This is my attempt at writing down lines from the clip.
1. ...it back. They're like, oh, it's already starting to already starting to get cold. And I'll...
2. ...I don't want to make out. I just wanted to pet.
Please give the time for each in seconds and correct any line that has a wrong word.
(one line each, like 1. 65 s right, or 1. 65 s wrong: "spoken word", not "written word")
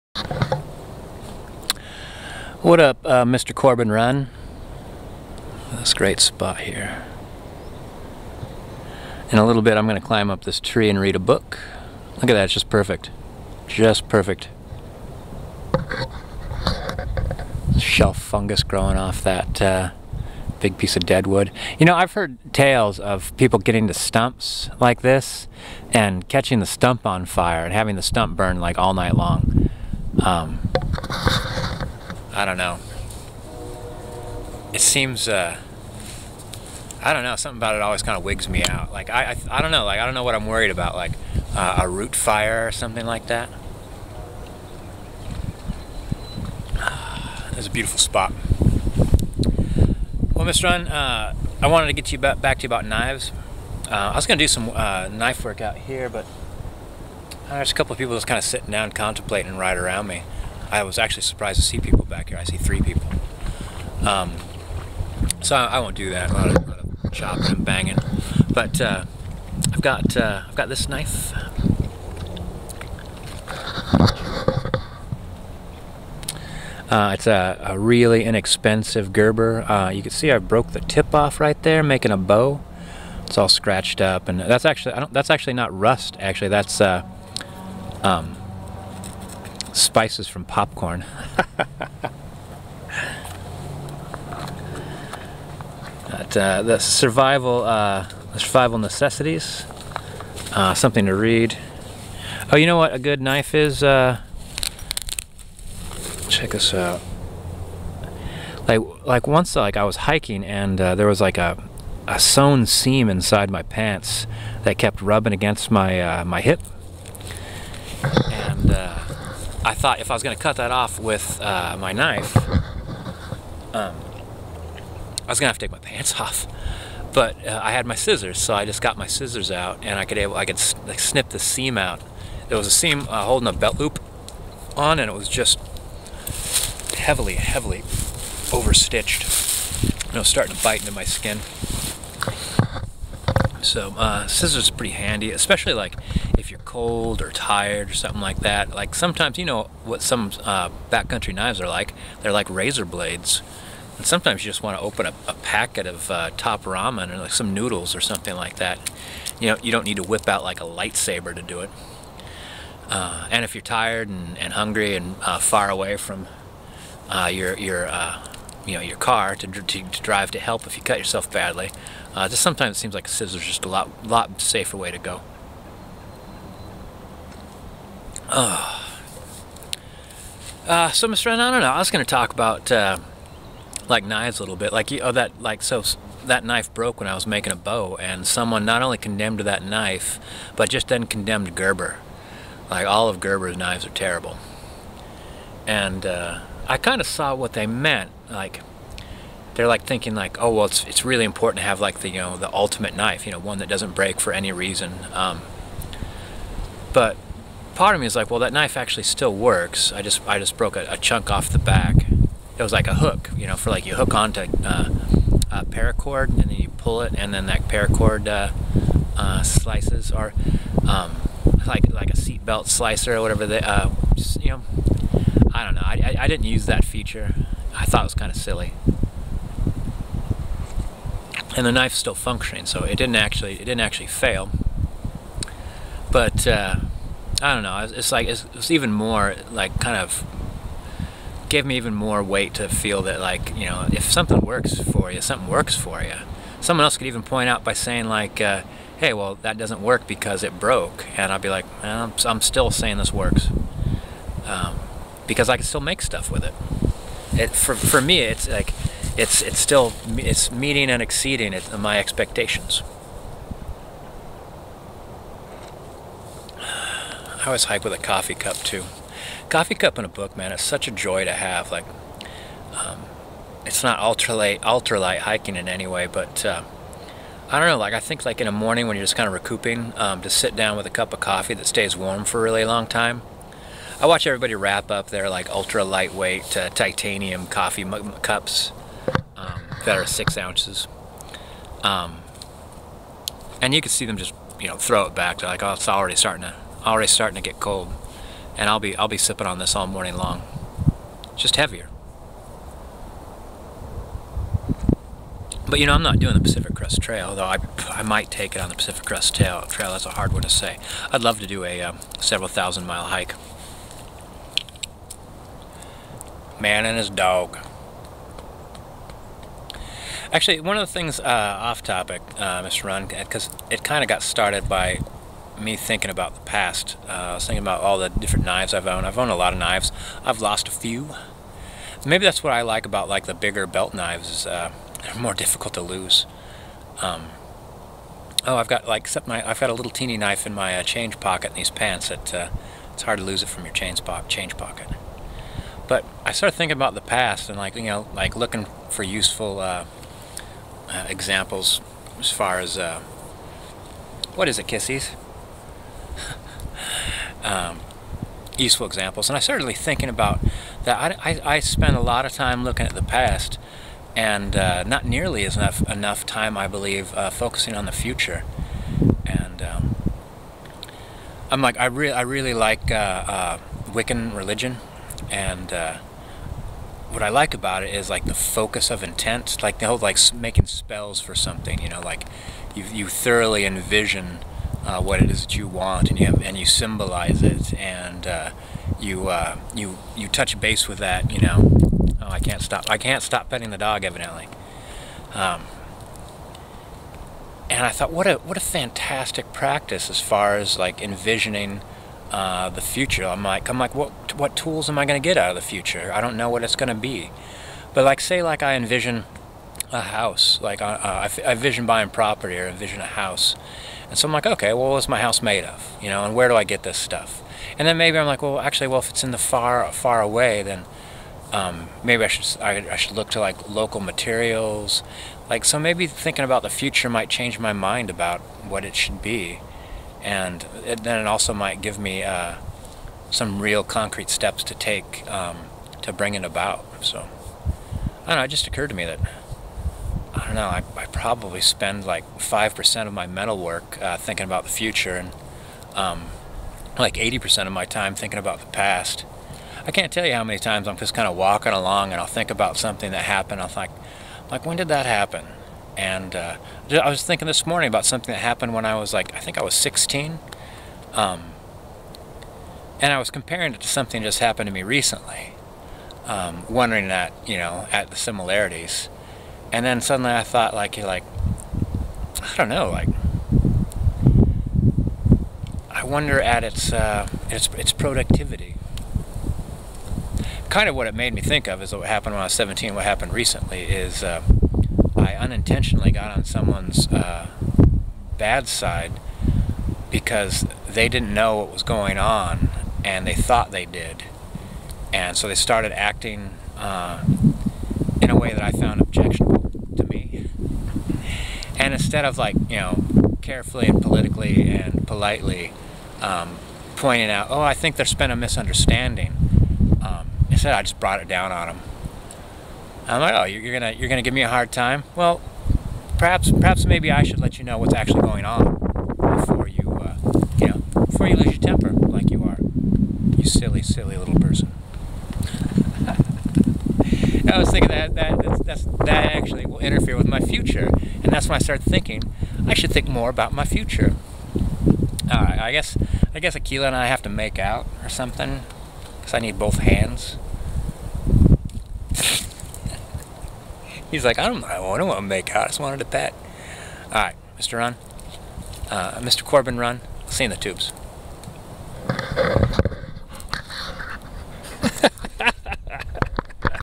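1. 295 s right
2. 544 s right.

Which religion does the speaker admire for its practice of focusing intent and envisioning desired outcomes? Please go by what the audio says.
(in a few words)
Wiccan.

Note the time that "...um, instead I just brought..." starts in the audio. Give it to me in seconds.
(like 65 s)
510 s.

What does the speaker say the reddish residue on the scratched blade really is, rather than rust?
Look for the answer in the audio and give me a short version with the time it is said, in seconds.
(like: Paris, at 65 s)
Spices from popcorn, at 89 s.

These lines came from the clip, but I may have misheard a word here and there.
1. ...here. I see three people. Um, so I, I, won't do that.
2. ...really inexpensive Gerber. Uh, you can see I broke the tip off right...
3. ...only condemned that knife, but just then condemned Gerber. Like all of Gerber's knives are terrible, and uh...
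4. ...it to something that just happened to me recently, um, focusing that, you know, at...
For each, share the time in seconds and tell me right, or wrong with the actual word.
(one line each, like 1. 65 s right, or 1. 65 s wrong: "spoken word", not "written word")
1. 62 s right
2. 77 s right
3. 188 s right
4. 463 s wrong: "wondering", not "focusing".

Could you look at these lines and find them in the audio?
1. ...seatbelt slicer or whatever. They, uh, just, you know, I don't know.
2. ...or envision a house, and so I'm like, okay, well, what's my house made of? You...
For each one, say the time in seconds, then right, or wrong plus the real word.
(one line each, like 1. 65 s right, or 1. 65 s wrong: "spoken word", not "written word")
1. 222 s right
2. 412 s right.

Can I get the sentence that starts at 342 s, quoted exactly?
That uh, it's hard to lose it from your change pocket.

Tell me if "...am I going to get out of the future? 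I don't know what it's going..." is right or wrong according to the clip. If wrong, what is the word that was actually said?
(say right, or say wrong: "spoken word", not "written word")
right.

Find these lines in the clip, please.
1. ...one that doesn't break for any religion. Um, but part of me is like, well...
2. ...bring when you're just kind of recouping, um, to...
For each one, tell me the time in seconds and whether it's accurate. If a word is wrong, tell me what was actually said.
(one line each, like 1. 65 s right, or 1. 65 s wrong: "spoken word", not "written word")
1. 203 s wrong: "reason", not "religion"
2. 278 s wrong: "morning", not "bring".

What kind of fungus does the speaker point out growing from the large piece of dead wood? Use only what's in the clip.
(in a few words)
Shelf fungus.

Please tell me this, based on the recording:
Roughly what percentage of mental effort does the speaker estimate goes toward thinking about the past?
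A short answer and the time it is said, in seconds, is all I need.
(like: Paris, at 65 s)
80%, at 447 s.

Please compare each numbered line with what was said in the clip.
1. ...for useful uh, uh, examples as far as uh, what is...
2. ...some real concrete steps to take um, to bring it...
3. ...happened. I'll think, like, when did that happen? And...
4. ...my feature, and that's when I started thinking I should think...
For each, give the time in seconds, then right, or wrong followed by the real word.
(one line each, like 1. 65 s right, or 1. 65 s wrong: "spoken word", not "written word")
1. 348 s right
2. 433 s right
3. 453 s right
4. 530 s wrong: "future", not "feature".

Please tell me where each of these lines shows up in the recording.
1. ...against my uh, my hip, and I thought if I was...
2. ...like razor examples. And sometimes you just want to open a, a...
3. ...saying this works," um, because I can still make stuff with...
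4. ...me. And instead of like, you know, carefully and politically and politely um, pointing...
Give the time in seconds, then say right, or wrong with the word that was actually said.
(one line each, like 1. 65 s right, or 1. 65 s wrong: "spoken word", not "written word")
1. 115 s right
2. 152 s wrong: "blades", not "examples"
3. 252 s right
4. 500 s right.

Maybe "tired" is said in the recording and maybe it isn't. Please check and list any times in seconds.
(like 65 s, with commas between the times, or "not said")
147 s, 163 s.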